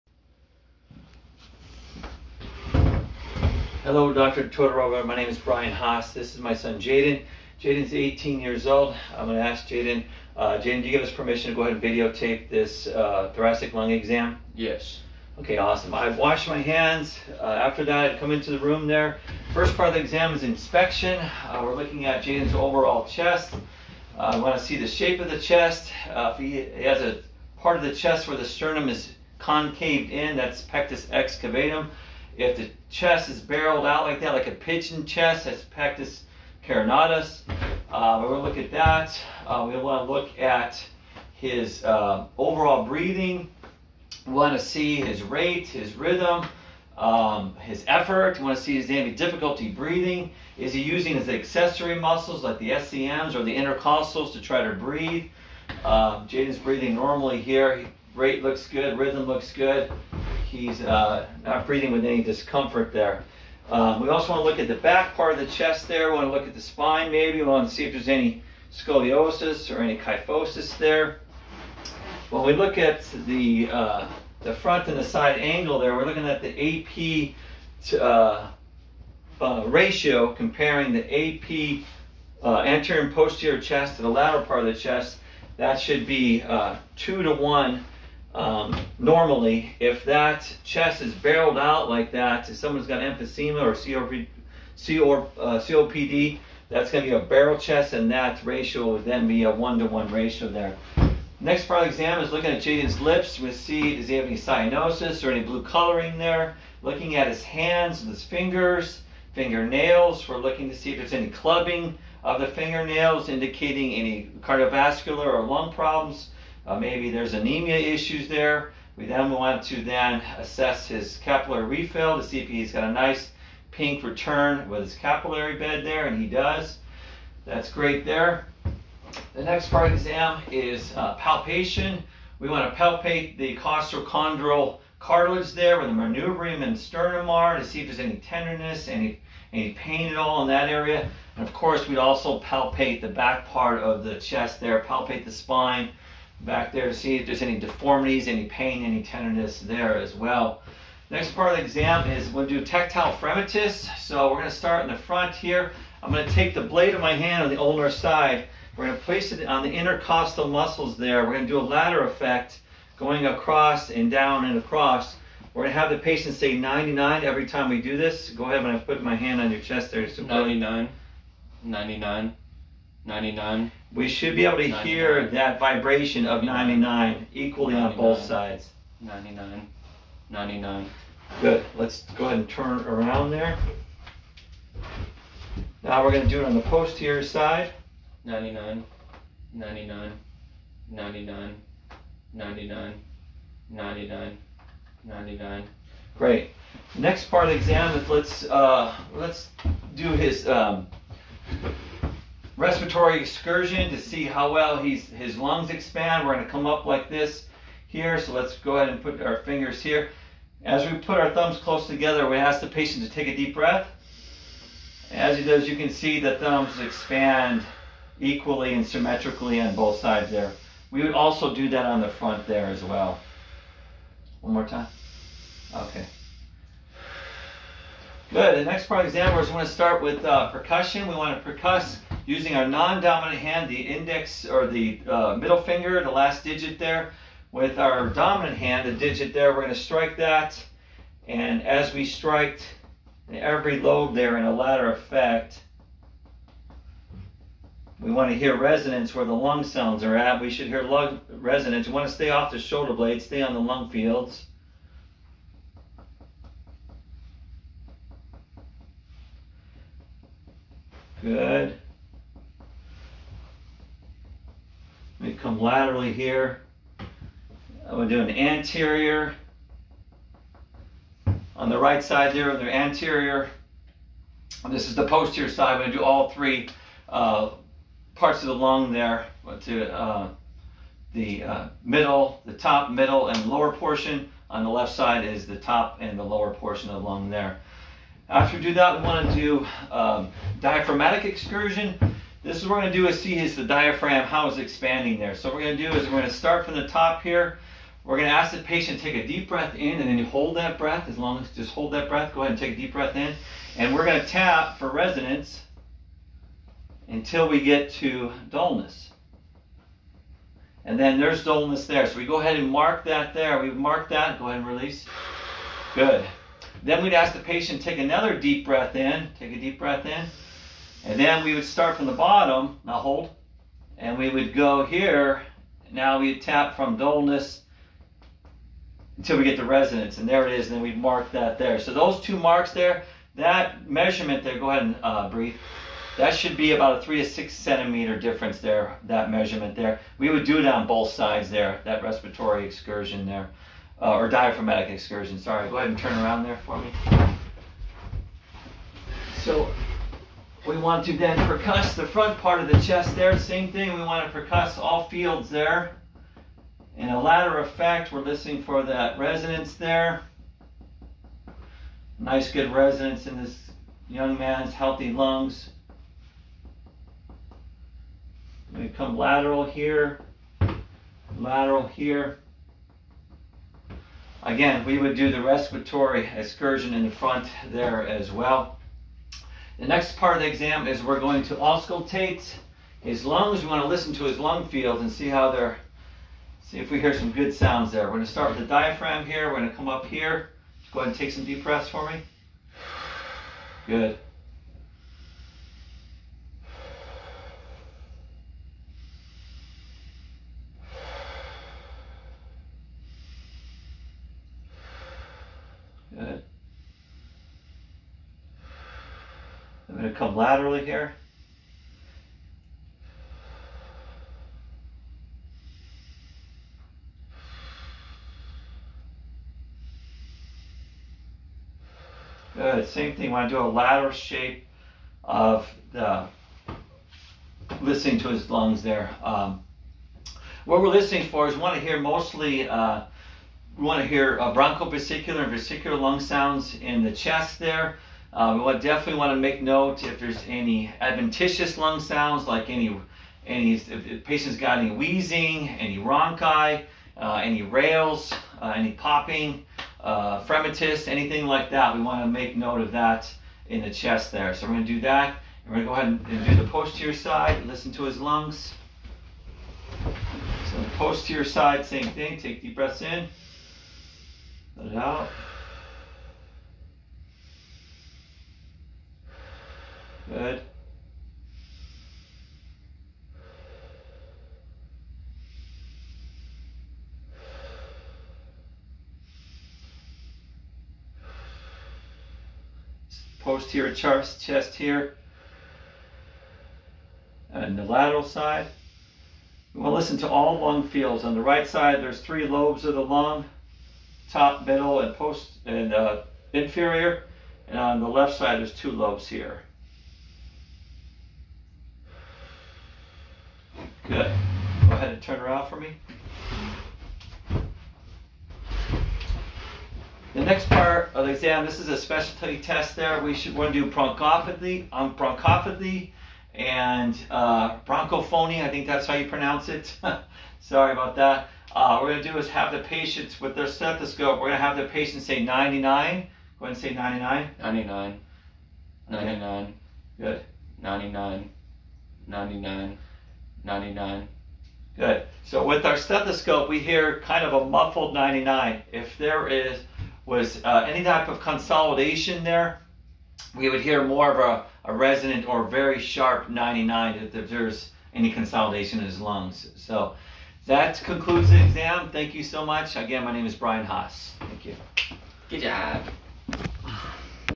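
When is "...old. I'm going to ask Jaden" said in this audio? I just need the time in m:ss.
0:08.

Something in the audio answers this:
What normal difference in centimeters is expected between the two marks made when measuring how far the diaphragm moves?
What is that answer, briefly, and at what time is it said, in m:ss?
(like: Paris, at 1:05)
3 to 6 centimeters, at 5:37.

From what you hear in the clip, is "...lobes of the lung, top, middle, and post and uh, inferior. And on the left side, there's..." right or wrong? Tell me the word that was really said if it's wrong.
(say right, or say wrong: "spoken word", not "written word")
right.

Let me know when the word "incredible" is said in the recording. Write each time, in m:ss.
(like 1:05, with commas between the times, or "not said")
not said.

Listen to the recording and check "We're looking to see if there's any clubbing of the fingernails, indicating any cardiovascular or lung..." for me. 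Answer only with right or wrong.
right.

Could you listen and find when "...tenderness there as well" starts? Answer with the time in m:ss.
2:29.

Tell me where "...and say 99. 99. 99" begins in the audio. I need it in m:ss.
8:46.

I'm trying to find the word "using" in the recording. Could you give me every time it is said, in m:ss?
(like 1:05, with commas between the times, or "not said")
0:50, 3:52.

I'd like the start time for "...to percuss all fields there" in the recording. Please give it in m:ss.
5:54.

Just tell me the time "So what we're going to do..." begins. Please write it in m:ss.
4:55.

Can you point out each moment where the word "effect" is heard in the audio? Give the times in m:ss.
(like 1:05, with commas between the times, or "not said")
2:42, 4:04, 5:57.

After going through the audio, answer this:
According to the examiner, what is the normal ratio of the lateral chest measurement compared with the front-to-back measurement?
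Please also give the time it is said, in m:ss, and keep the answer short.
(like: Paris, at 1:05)
2 to 1, at 1:26.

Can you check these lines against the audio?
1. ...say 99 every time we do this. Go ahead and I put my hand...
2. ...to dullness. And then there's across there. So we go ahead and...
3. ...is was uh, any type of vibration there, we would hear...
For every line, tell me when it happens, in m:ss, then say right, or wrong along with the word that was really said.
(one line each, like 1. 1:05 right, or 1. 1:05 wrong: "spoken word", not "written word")
1. 2:46 right
2. 5:07 wrong: "dullness", not "across"
3. 8:59 wrong: "consolidation", not "vibration".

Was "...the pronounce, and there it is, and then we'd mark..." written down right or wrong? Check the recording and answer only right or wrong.
wrong.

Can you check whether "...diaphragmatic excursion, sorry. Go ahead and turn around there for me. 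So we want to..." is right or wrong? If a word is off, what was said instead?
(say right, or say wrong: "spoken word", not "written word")
right.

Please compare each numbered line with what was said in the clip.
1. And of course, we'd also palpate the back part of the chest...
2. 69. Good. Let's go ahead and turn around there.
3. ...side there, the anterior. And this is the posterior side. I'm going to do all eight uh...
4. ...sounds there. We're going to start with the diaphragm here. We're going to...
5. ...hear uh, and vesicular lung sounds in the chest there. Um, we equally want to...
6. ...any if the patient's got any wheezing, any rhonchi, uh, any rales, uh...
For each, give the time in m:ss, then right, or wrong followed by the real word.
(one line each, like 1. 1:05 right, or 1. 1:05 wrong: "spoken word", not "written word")
1. 2:21 right
2. 3:00 wrong: "99", not "69"
3. 4:32 wrong: "three", not "eight"
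4. 6:27 right
5. 7:14 wrong: "definitely", not "equally"
6. 7:23 right.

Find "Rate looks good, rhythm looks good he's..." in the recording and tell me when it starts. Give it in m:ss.
0:58.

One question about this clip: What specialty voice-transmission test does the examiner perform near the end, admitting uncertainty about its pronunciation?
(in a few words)
bronchophony.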